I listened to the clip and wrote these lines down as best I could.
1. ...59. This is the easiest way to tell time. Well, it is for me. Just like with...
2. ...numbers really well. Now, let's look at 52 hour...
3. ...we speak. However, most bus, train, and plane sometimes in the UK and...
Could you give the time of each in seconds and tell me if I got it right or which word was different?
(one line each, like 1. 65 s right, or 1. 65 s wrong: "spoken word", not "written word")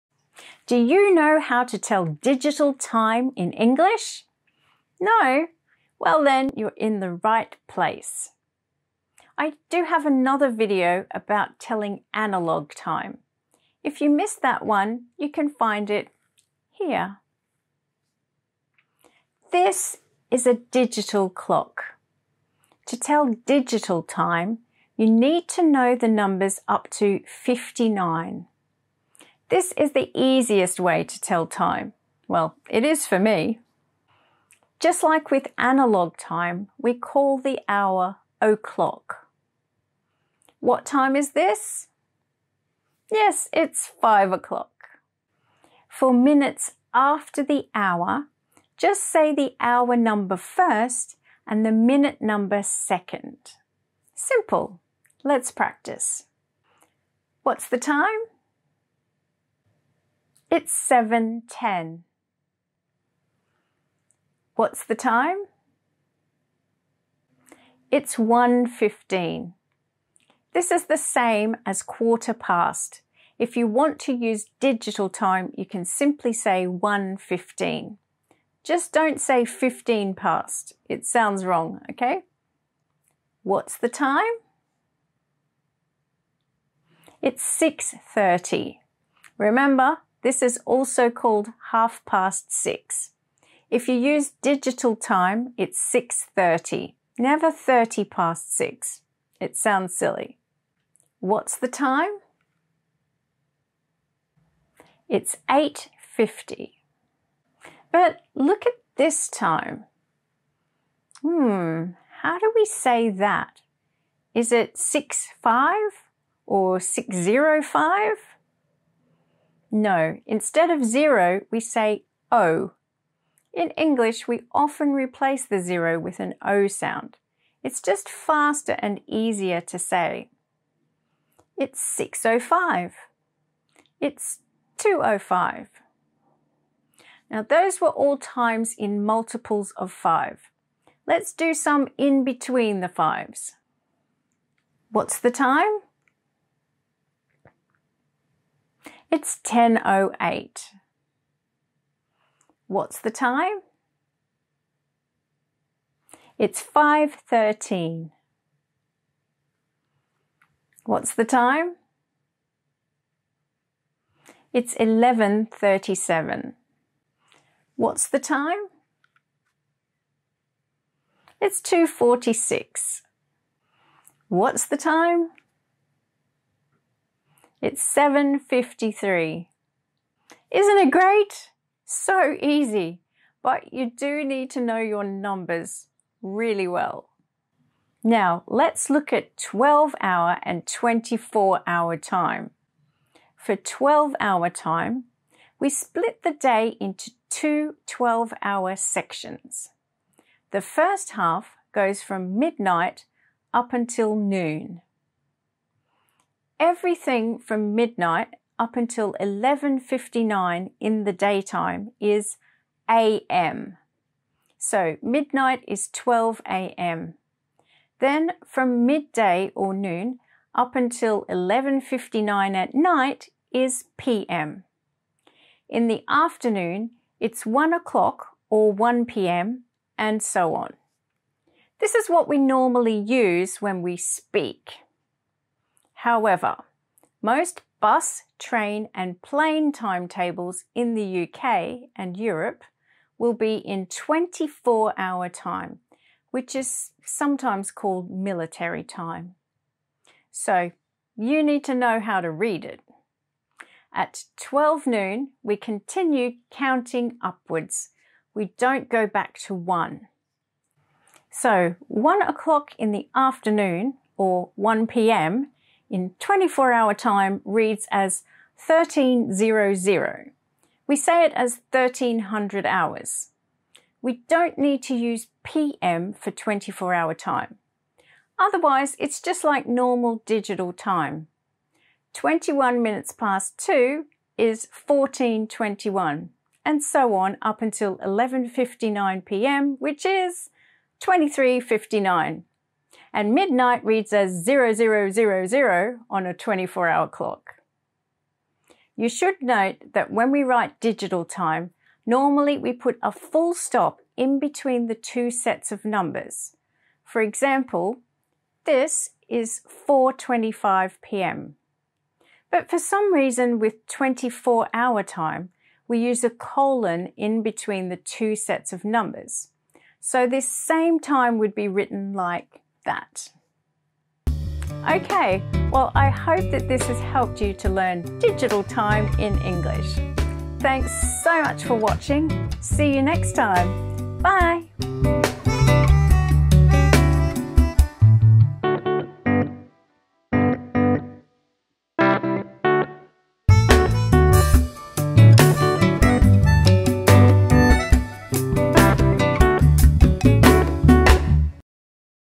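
1. 27 s right
2. 185 s wrong: "12", not "52"
3. 233 s wrong: "timetables", not "sometimes".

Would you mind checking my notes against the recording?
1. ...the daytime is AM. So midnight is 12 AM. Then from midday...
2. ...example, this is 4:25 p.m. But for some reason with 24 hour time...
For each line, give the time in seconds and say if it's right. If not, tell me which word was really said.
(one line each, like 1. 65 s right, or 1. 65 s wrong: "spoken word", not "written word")
1. 211 s right
2. 307 s right.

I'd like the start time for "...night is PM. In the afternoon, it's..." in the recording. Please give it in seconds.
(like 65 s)
222 s.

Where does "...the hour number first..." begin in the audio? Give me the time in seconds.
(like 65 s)
49 s.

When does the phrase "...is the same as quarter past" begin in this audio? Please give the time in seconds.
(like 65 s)
70 s.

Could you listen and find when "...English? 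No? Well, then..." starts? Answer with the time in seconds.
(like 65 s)
3 s.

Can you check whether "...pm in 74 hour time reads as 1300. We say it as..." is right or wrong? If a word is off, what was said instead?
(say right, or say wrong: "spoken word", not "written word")
wrong: "24", not "74".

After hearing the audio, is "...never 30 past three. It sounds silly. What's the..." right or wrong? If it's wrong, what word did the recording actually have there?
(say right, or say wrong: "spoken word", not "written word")
wrong: "six", not "three".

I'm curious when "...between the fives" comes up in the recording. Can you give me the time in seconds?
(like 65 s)
142 s.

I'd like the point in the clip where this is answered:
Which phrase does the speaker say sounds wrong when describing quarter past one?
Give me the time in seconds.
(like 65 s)
79 s.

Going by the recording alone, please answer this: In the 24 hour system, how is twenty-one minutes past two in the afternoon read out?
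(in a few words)
1421.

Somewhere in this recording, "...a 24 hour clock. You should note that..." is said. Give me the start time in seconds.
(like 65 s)
296 s.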